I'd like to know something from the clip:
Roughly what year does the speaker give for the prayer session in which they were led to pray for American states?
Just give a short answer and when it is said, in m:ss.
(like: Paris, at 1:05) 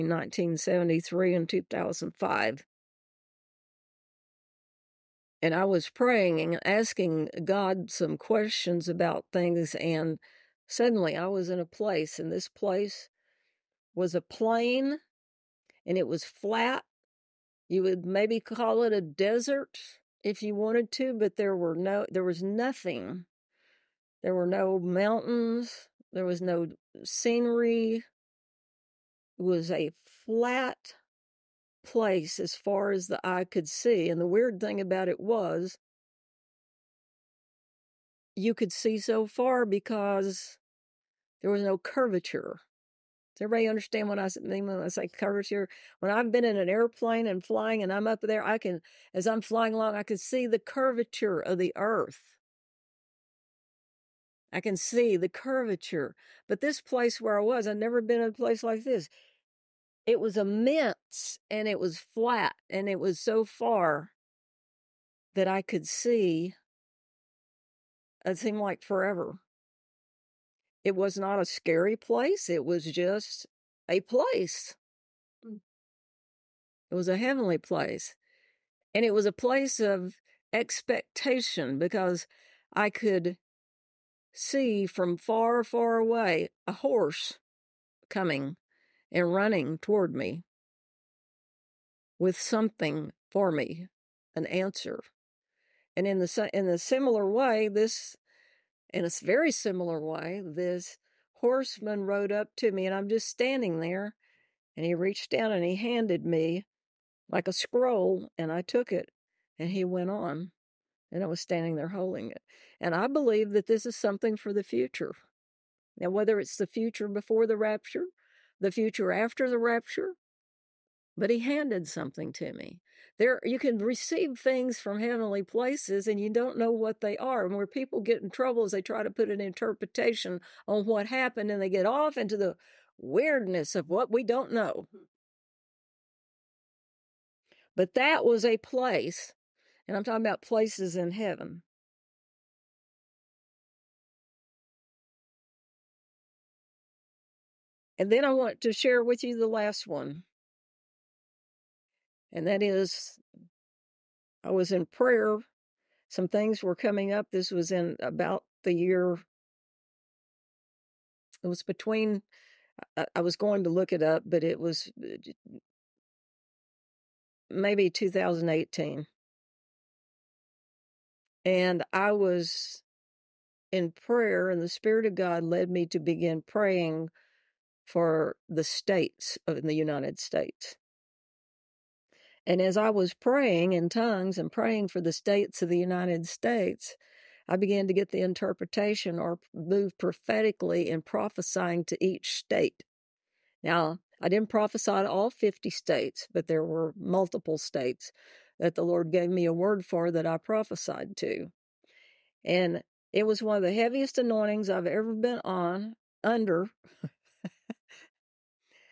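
2018, at 2:47.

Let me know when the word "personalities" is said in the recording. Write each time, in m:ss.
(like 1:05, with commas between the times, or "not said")
not said.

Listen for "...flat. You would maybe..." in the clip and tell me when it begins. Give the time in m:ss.
0:16.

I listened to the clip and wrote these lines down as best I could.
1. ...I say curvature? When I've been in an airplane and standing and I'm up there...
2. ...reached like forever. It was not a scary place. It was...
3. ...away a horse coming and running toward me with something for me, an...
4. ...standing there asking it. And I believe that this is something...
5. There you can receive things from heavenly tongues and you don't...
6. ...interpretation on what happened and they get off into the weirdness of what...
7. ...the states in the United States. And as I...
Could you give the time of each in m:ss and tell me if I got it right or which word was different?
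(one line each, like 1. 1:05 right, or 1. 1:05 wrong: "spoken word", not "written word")
1. 0:44 wrong: "flying", not "standing"
2. 1:08 wrong: "seemed", not "reached"
3. 1:25 right
4. 1:51 wrong: "holding", not "asking"
5. 2:03 wrong: "places", not "tongues"
6. 2:09 right
7. 2:58 right.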